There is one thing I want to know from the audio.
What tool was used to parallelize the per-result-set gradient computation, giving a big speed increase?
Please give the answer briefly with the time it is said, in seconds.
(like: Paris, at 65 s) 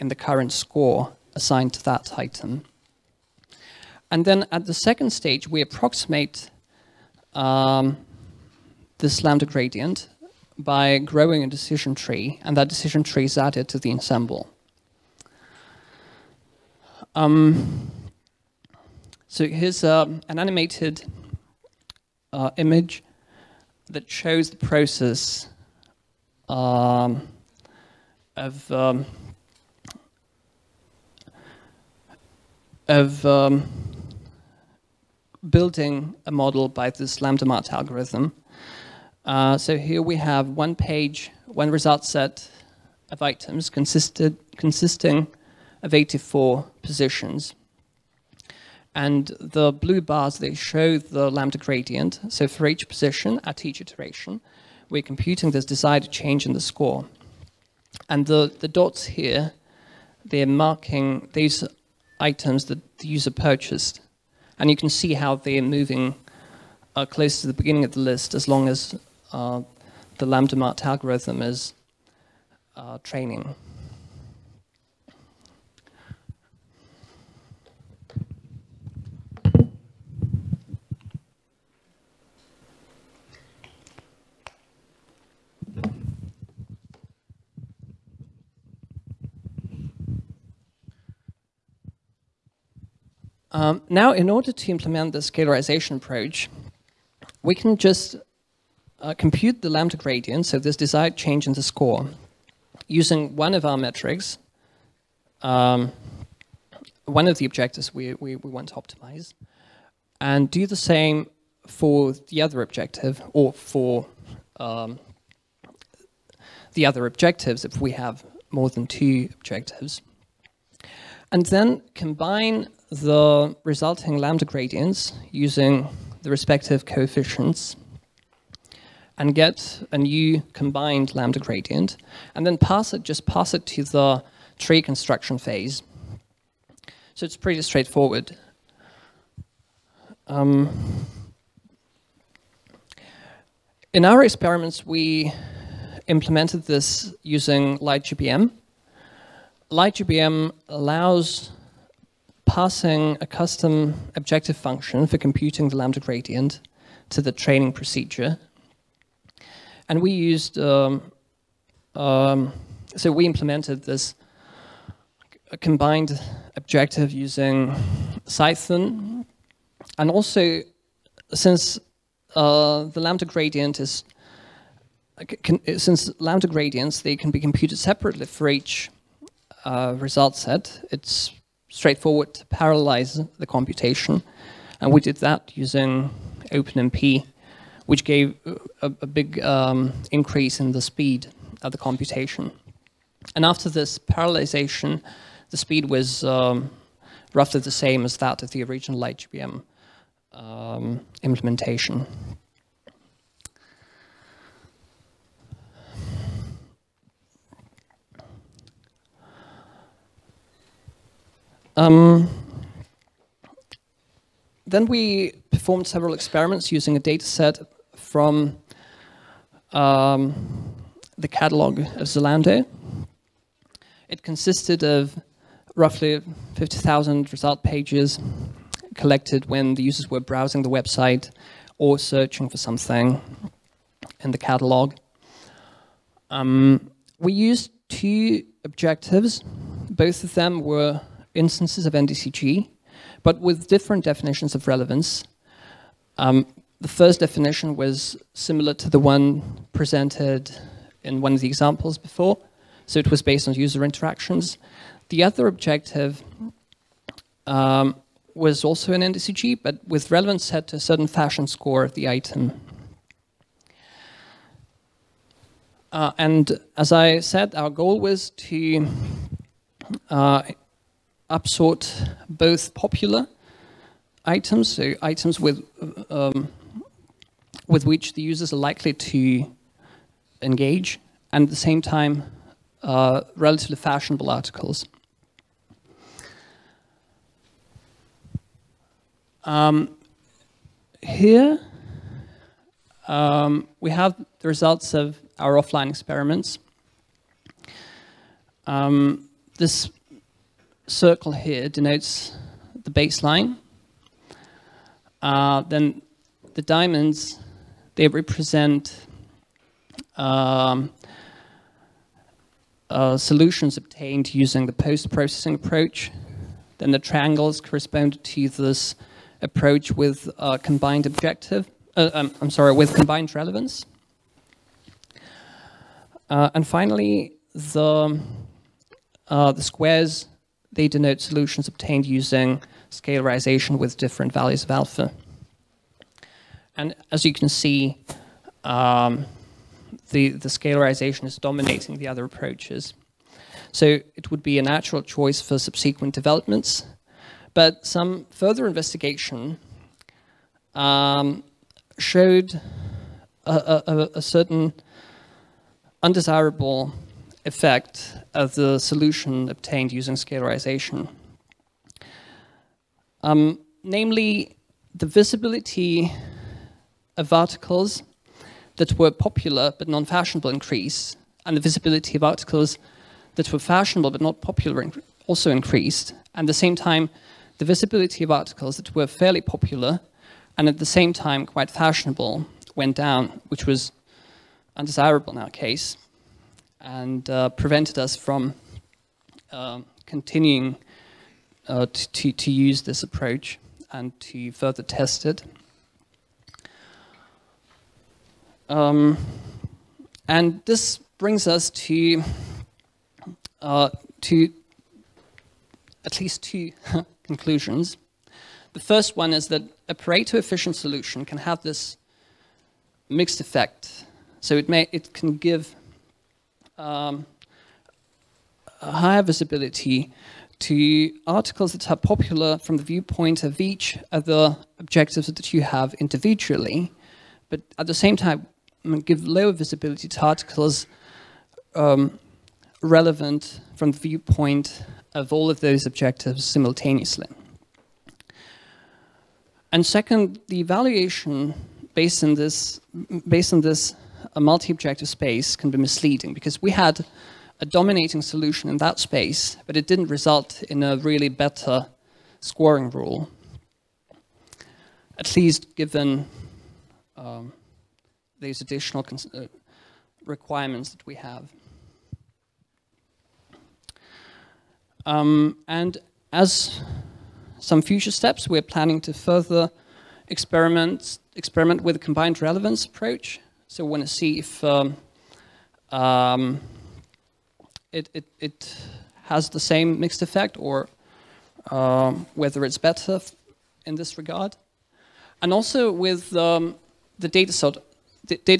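OpenMP, at 186 s.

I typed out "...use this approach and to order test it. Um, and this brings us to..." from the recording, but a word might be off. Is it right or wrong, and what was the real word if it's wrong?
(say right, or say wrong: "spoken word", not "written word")
wrong: "further", not "order".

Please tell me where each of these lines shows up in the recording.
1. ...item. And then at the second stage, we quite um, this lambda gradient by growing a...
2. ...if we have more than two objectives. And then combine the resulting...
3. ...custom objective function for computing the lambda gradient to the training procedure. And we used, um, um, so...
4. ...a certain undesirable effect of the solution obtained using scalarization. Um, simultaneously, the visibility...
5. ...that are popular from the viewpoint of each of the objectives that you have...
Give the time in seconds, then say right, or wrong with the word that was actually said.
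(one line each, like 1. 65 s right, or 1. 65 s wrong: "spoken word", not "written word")
1. 2 s wrong: "approximate", not "quite"
2. 117 s right
3. 153 s right
4. 354 s wrong: "namely", not "simultaneously"
5. 421 s right.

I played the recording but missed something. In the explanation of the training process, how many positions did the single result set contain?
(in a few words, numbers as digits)
84.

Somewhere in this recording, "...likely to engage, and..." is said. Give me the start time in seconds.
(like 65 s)
278 s.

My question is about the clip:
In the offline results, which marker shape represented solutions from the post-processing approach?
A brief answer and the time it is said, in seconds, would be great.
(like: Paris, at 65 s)
diamonds, at 306 s.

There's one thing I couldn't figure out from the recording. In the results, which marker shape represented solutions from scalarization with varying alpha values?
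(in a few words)
squares.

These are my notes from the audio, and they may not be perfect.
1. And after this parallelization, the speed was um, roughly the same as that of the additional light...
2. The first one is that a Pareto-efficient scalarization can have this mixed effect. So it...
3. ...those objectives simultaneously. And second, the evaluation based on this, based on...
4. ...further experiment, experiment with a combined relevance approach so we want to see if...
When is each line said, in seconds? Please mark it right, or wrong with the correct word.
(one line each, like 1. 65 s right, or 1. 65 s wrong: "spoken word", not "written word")
1. 193 s wrong: "original", not "additional"
2. 408 s wrong: "solution", not "scalarization"
3. 435 s right
4. 469 s right.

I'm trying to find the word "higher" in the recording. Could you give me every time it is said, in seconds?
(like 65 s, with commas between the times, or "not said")
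418 s.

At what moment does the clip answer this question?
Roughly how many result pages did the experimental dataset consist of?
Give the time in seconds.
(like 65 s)
226 s.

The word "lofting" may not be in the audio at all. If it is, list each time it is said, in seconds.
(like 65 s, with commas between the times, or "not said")
not said.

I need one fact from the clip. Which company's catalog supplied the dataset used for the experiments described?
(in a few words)
Zalando.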